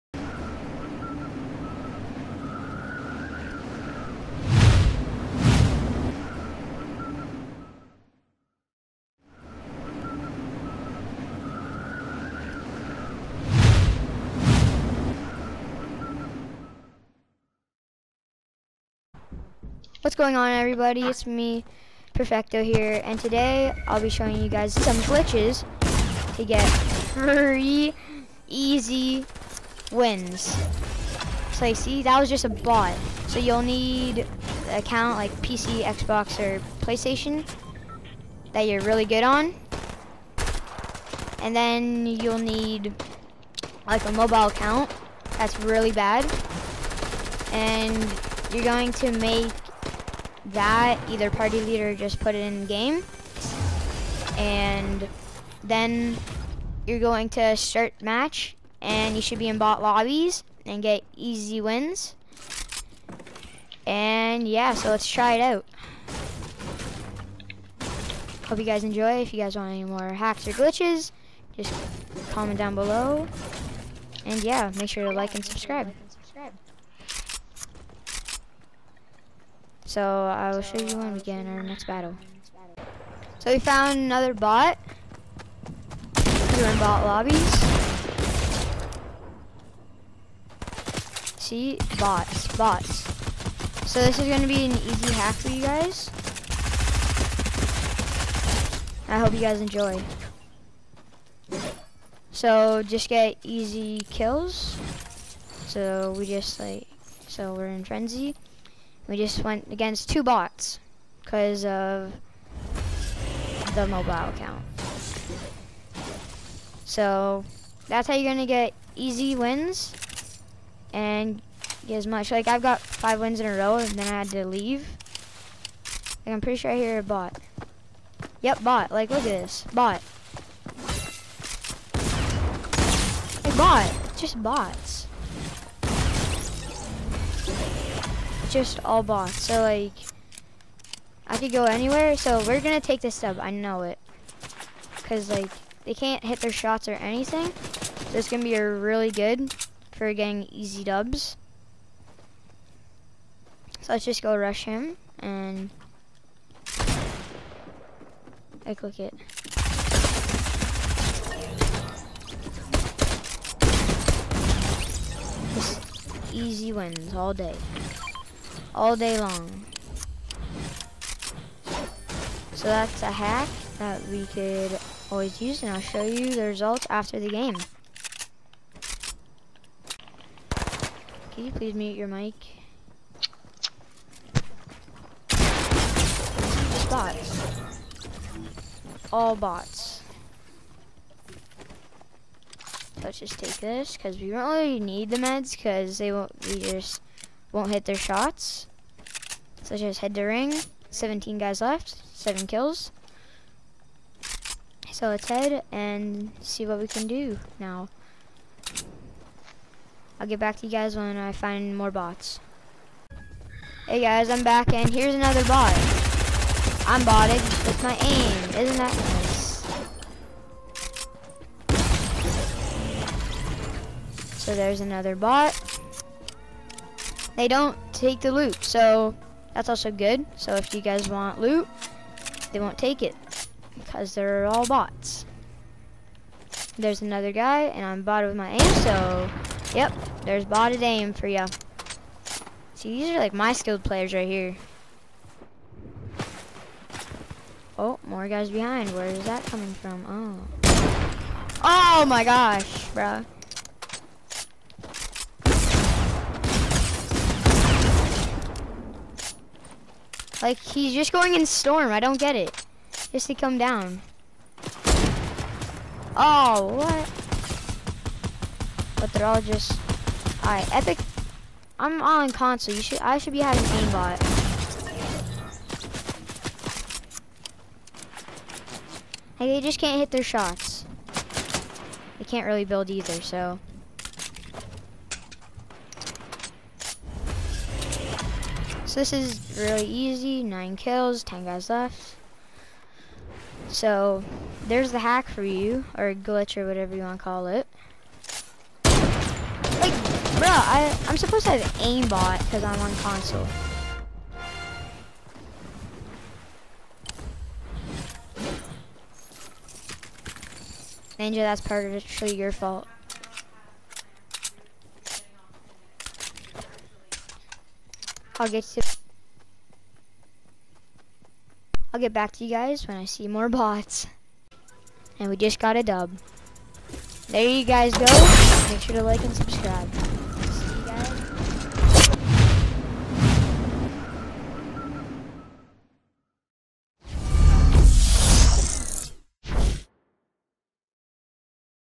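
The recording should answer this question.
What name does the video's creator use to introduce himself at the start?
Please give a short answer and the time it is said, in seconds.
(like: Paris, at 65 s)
Perfecto, at 22 s.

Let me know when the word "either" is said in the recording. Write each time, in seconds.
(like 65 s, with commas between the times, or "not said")
51 s, 282 s.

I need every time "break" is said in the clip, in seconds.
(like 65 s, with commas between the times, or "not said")
not said.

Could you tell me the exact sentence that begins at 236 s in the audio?
There's another guy, and I'm botted with my aim, so yep, there's botted aim for ya.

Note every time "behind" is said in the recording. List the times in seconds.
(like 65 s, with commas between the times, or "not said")
248 s.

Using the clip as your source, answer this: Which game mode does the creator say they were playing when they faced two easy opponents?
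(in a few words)
frenzy.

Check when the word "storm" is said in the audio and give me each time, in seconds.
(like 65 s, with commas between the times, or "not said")
261 s.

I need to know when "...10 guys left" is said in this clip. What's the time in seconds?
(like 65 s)
291 s.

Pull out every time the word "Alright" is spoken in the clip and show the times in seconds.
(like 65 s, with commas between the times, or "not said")
270 s.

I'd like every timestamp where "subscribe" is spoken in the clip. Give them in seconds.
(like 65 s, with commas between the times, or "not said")
75 s, 329 s.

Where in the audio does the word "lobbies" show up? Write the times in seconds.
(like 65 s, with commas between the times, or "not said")
59 s, 87 s.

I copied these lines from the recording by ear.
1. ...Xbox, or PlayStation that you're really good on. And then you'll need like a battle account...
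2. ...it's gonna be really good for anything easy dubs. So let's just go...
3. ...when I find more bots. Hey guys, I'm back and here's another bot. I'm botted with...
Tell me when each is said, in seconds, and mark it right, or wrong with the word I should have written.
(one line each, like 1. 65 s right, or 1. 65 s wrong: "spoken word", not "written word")
1. 35 s wrong: "mobile", not "battle"
2. 148 s wrong: "getting", not "anything"
3. 210 s right.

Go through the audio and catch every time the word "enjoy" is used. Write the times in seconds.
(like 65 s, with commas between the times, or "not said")
68 s, 99 s.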